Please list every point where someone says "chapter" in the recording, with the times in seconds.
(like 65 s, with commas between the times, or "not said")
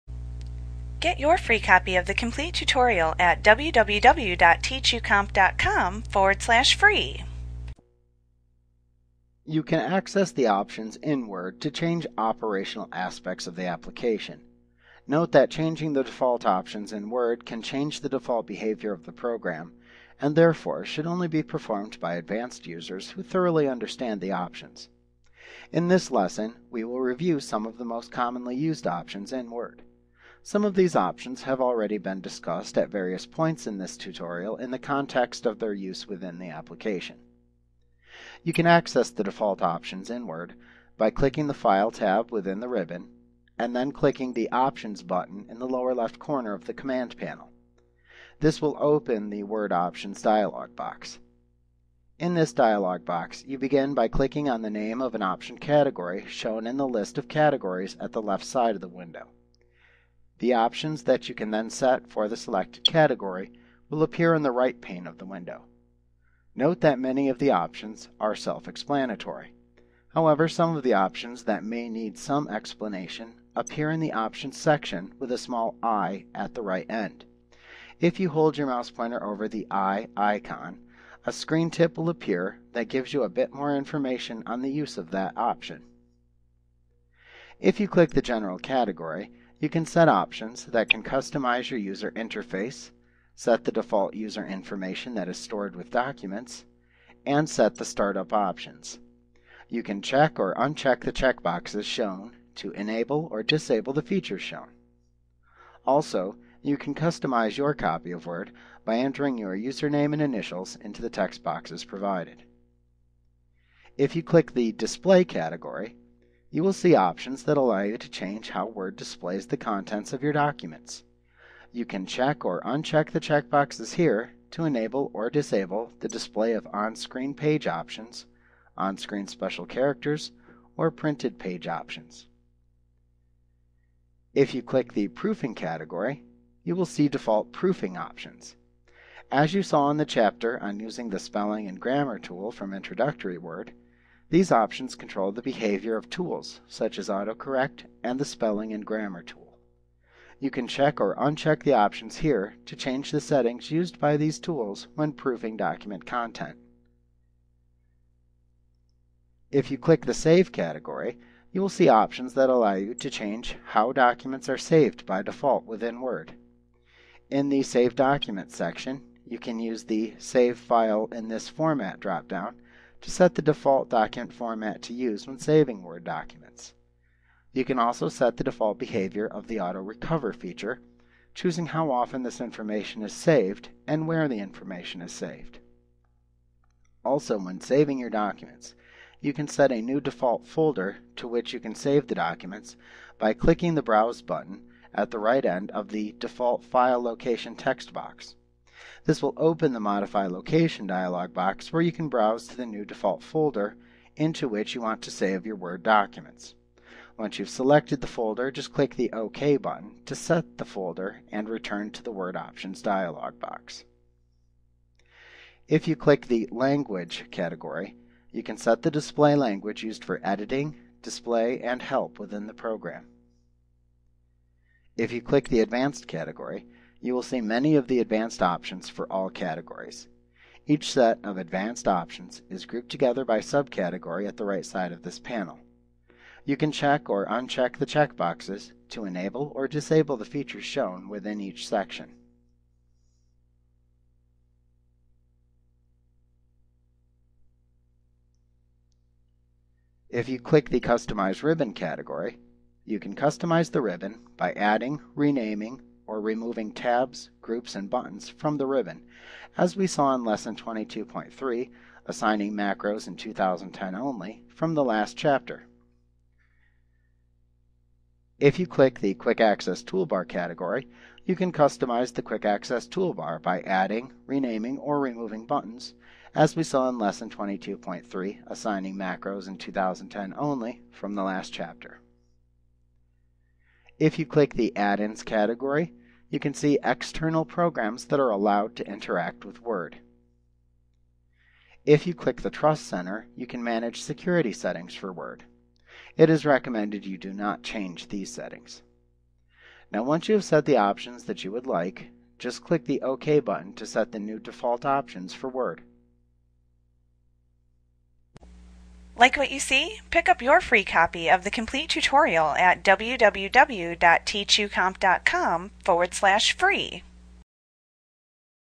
140 s, 265 s, 281 s.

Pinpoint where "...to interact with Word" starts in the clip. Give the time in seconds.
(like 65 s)
288 s.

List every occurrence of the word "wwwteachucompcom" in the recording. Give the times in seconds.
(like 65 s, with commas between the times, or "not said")
3 s, 312 s.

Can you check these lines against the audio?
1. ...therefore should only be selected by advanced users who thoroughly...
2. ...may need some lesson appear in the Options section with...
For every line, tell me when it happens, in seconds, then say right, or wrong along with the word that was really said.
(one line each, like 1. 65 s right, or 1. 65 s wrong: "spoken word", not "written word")
1. 20 s wrong: "performed", not "selected"
2. 71 s wrong: "explanation", not "lesson".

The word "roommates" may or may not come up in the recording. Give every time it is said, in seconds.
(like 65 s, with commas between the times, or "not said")
not said.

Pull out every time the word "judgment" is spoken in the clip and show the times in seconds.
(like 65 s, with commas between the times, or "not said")
not said.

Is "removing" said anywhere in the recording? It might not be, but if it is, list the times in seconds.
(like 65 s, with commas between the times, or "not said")
256 s, 274 s.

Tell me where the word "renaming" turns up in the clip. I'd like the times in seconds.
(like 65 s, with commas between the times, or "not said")
255 s, 274 s.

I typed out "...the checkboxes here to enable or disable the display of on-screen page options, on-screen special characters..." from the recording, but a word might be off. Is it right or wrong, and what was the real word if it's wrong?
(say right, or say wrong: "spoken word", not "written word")
right.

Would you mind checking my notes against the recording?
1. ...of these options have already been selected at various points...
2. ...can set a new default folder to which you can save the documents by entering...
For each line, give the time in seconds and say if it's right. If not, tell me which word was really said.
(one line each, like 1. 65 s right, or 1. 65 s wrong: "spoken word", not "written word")
1. 30 s wrong: "discussed", not "selected"
2. 189 s wrong: "clicking", not "entering".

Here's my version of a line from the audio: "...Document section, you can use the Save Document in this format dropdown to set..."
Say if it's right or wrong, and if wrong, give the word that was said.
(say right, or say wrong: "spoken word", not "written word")
wrong: "File", not "Document".